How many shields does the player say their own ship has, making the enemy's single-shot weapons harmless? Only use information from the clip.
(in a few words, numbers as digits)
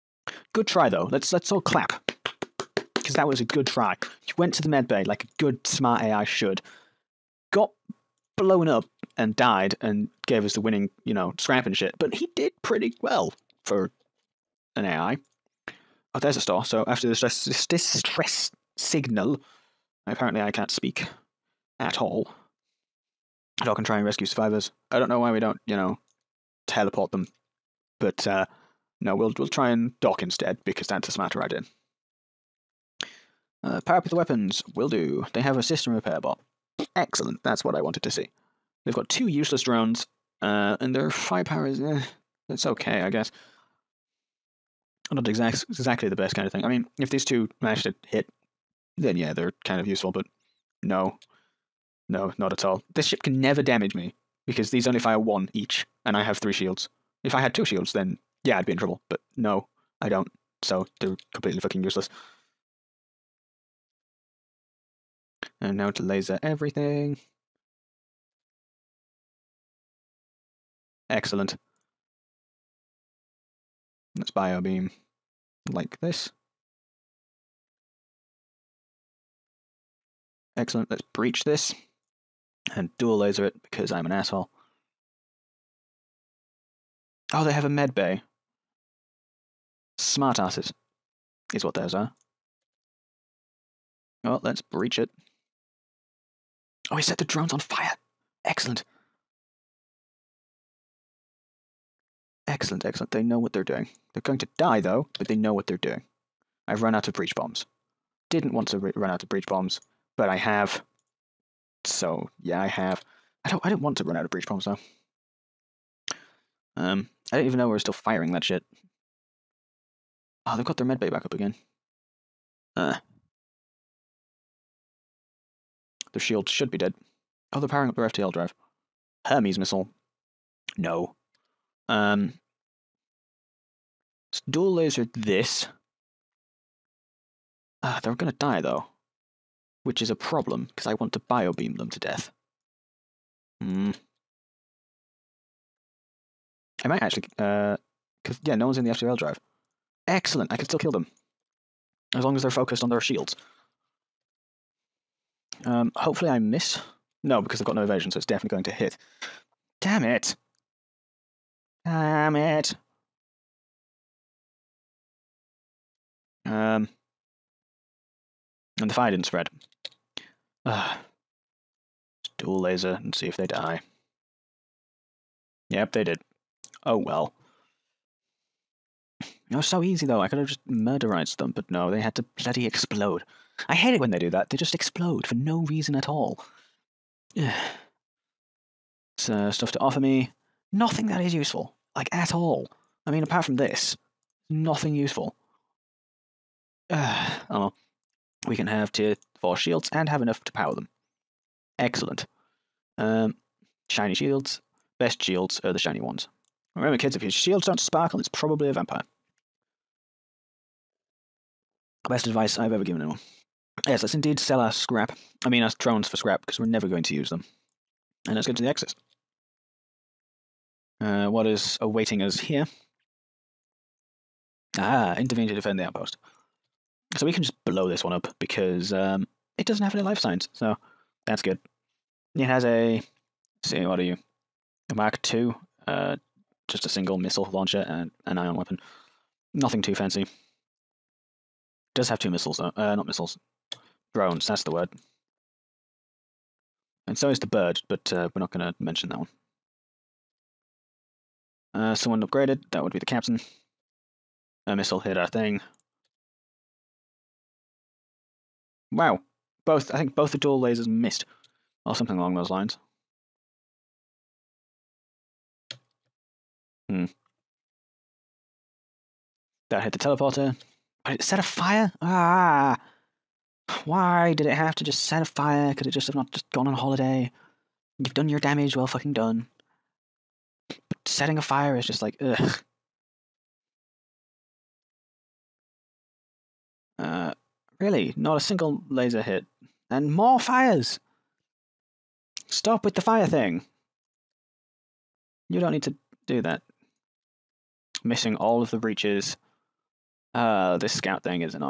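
3.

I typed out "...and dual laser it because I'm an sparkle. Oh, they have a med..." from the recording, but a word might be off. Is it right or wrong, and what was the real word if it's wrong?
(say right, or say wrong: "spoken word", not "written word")
wrong: "asshole", not "sparkle".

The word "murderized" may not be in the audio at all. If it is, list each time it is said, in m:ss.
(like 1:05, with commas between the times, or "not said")
3:00.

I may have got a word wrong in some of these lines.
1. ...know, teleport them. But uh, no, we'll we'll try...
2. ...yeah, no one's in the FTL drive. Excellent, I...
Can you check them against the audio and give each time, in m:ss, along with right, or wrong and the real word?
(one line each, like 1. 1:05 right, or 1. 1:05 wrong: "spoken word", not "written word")
1. 0:25 right
2. 2:28 right.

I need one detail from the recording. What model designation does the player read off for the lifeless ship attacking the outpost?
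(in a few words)
Mark II.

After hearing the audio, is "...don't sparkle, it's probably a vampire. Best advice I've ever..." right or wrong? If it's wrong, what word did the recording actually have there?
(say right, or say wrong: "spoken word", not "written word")
right.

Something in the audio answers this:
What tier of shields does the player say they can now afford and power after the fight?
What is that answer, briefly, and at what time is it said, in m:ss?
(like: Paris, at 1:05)
tier 4, at 3:18.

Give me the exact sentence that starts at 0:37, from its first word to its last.
That's what I wanted to see.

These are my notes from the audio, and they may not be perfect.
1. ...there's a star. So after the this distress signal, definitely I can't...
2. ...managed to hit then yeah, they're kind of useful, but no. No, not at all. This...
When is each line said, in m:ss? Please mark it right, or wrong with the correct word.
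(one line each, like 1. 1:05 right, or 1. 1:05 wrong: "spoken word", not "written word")
1. 0:16 wrong: "apparently", not "definitely"
2. 0:47 right.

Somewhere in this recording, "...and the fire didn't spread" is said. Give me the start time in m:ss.
2:48.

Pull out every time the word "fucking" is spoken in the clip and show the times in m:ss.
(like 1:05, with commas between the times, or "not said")
1:01, 4:38.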